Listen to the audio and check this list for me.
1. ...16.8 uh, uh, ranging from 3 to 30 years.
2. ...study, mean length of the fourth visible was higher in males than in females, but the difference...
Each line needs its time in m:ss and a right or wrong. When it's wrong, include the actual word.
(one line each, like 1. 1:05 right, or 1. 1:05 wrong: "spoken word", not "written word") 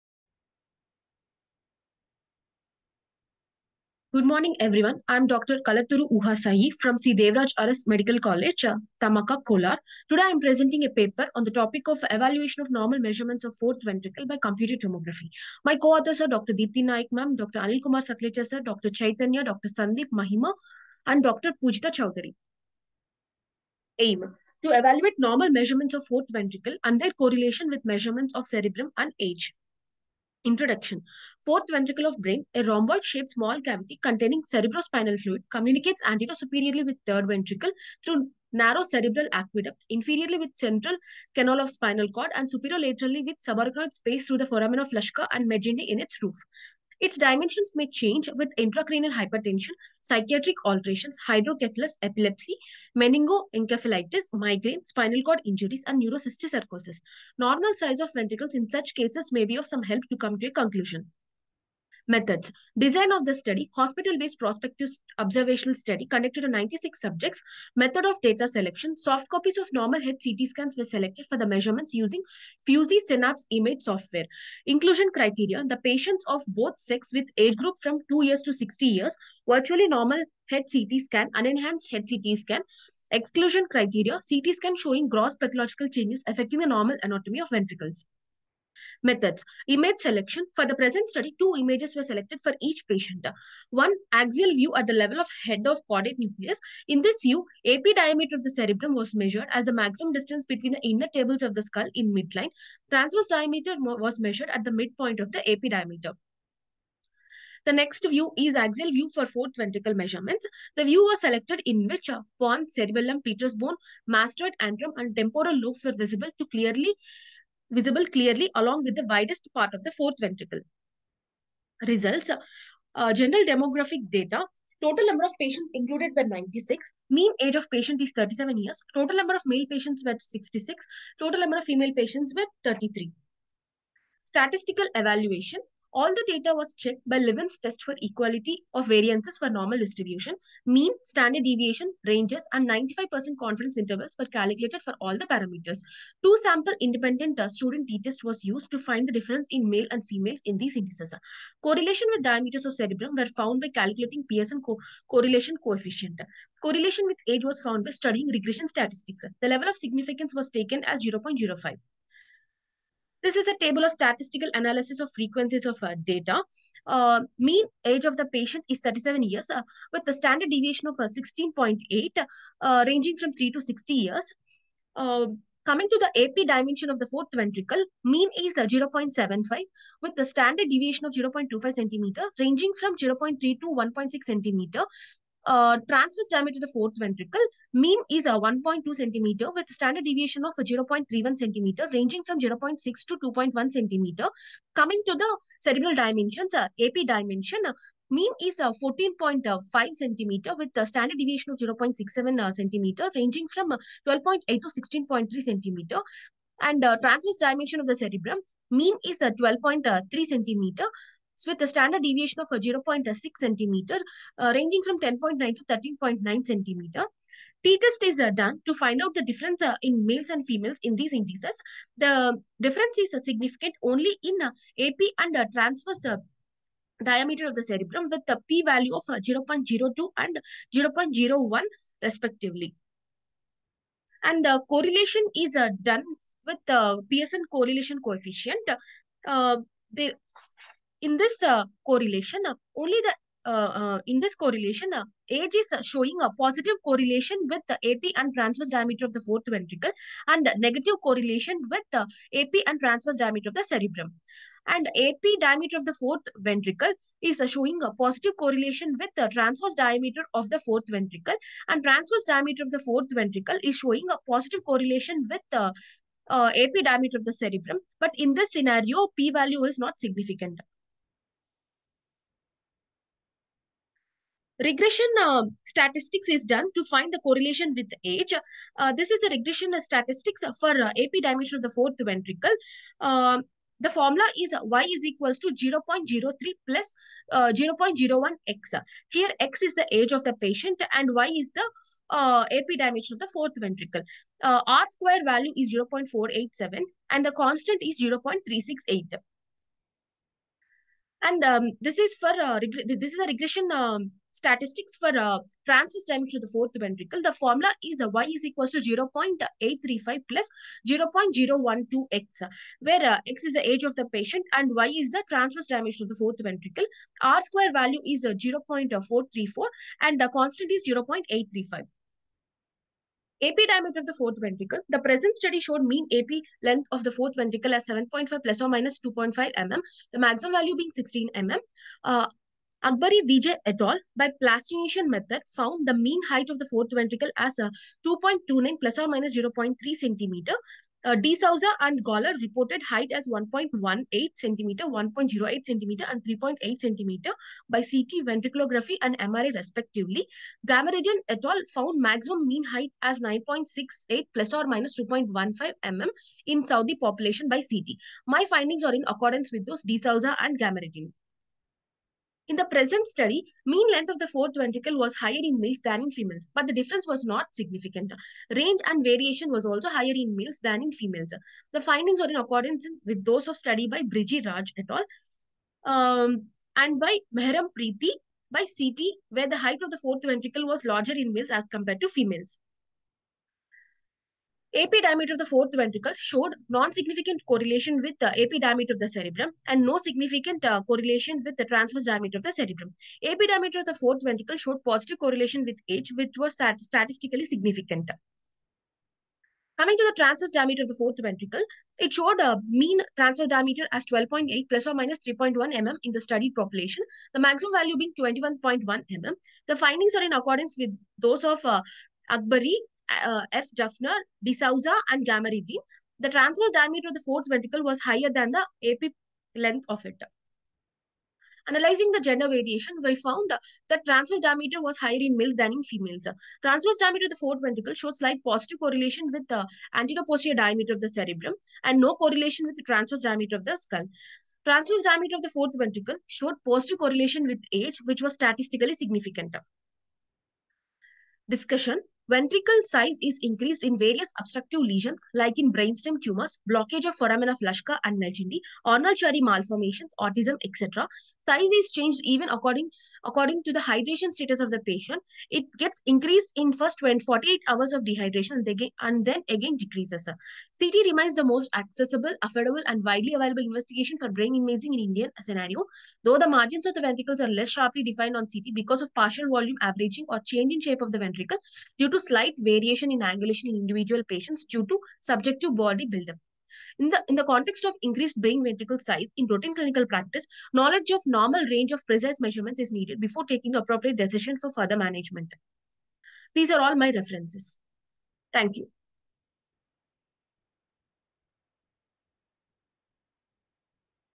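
1. 2:50 wrong: "60", not "30"
2. 6:03 wrong: "ventricle", not "visible".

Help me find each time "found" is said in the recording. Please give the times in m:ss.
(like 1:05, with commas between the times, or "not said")
2:33, 2:37, 5:35, 5:51, 7:03.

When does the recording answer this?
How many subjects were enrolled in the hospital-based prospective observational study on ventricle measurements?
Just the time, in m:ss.
1:06.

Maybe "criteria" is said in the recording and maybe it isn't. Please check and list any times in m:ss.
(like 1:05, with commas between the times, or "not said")
1:15, 1:23.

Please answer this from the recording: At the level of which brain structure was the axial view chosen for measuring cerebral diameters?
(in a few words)
head of caudate nucleus.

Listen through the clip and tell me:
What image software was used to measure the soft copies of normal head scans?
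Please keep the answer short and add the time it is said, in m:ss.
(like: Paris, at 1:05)
Fuji Synapse, at 1:12.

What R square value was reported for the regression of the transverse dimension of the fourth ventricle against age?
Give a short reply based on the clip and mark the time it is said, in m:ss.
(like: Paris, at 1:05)
0.434, at 5:18.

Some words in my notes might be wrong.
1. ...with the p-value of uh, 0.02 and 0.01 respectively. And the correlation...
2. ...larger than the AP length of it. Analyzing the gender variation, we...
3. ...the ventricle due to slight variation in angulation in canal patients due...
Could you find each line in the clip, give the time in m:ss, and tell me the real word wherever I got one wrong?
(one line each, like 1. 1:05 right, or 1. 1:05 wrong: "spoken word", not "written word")
1. 3:48 right
2. 6:58 wrong: "higher", not "larger"
3. 7:51 wrong: "individual", not "canal".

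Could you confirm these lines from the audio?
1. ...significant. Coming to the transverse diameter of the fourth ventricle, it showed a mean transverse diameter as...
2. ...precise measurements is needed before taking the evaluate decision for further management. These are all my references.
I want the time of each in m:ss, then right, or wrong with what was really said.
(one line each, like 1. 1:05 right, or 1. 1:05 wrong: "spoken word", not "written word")
1. 6:37 right
2. 8:02 wrong: "appropriate", not "evaluate".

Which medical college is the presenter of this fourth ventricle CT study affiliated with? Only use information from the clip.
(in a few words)
C. Devaraj Urs Medical College.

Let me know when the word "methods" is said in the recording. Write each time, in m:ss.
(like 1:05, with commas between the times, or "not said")
1:02, 1:07, 1:29, 5:35.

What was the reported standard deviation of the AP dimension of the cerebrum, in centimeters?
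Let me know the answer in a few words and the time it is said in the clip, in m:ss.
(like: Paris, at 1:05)
0.67, at 3:21.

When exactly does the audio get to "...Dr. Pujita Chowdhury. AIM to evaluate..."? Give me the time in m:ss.
0:21.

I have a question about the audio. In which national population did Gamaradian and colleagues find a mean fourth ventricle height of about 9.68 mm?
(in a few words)
Saudi.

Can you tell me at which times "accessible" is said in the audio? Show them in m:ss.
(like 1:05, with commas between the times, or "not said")
7:41.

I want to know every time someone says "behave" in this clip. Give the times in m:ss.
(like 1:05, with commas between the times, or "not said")
not said.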